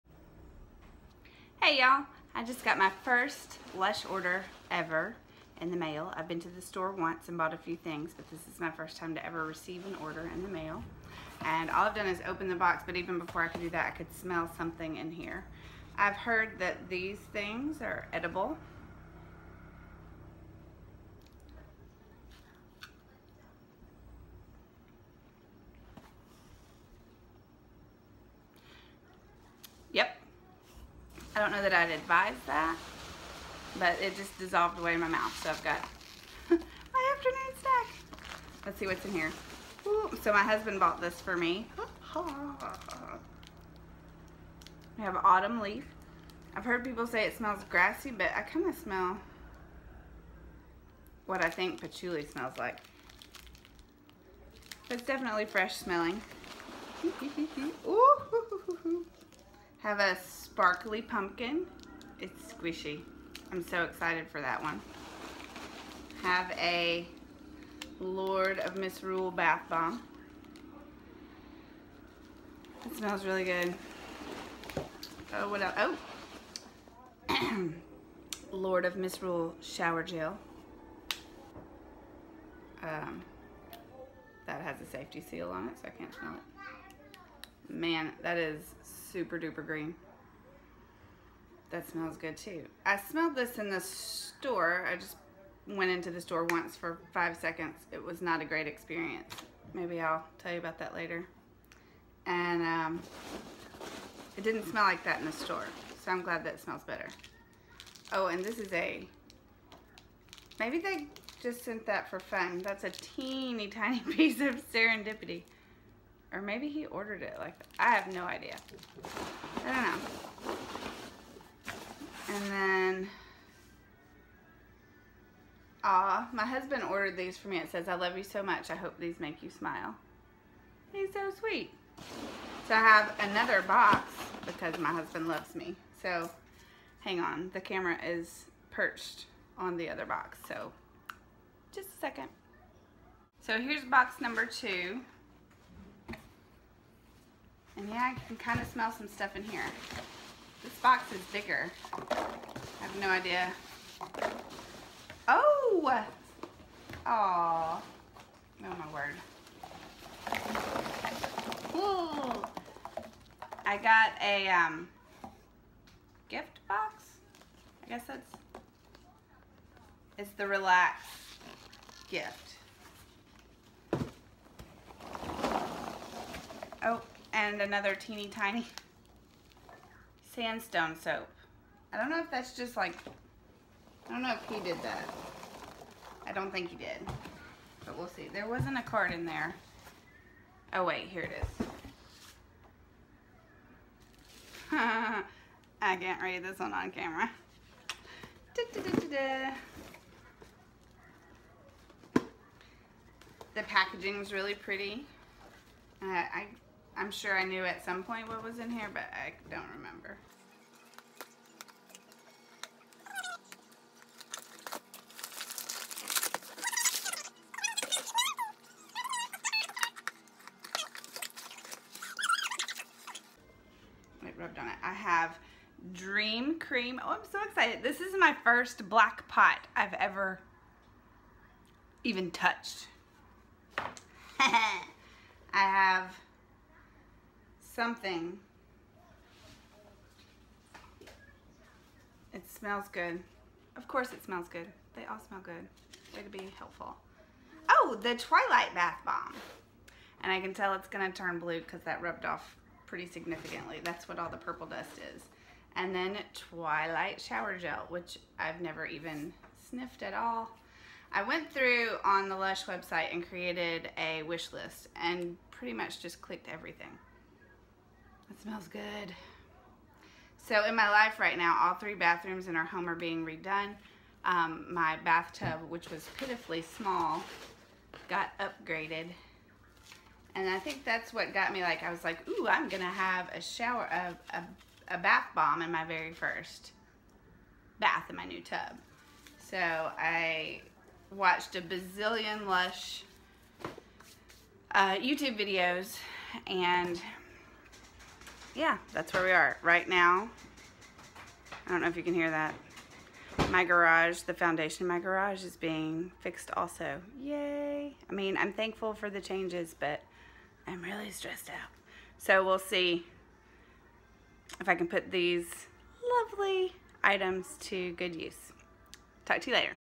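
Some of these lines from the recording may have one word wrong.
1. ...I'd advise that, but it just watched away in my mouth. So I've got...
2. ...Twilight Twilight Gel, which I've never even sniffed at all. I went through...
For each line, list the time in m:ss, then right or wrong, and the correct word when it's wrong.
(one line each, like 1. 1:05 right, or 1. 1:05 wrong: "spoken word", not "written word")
1. 0:31 wrong: "dissolved", not "watched"
2. 4:16 wrong: "Shower", not "Twilight".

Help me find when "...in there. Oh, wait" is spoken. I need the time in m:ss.
3:09.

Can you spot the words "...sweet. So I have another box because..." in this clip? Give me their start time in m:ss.
2:11.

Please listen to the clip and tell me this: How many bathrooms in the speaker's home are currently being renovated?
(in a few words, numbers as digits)
3.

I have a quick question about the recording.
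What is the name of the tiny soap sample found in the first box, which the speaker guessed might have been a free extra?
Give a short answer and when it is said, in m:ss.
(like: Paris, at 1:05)
Serendipity, at 1:54.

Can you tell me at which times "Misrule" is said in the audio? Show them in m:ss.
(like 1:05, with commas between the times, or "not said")
1:08, 1:18.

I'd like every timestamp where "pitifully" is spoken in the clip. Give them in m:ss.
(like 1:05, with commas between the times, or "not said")
4:36.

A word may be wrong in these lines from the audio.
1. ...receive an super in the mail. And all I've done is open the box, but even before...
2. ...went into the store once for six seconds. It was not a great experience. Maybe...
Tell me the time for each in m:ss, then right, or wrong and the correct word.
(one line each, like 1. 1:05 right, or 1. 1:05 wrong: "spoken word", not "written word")
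1. 0:09 wrong: "order", not "super"
2. 1:35 wrong: "five", not "six".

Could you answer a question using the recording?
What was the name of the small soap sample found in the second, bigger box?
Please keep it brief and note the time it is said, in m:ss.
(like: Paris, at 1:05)
Sandstone, at 3:00.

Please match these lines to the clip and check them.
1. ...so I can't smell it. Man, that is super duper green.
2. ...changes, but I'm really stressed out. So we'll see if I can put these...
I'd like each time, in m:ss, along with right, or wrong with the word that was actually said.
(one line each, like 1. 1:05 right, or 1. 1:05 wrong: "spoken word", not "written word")
1. 1:25 right
2. 5:09 right.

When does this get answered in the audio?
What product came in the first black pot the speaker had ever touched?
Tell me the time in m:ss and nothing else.
3:45.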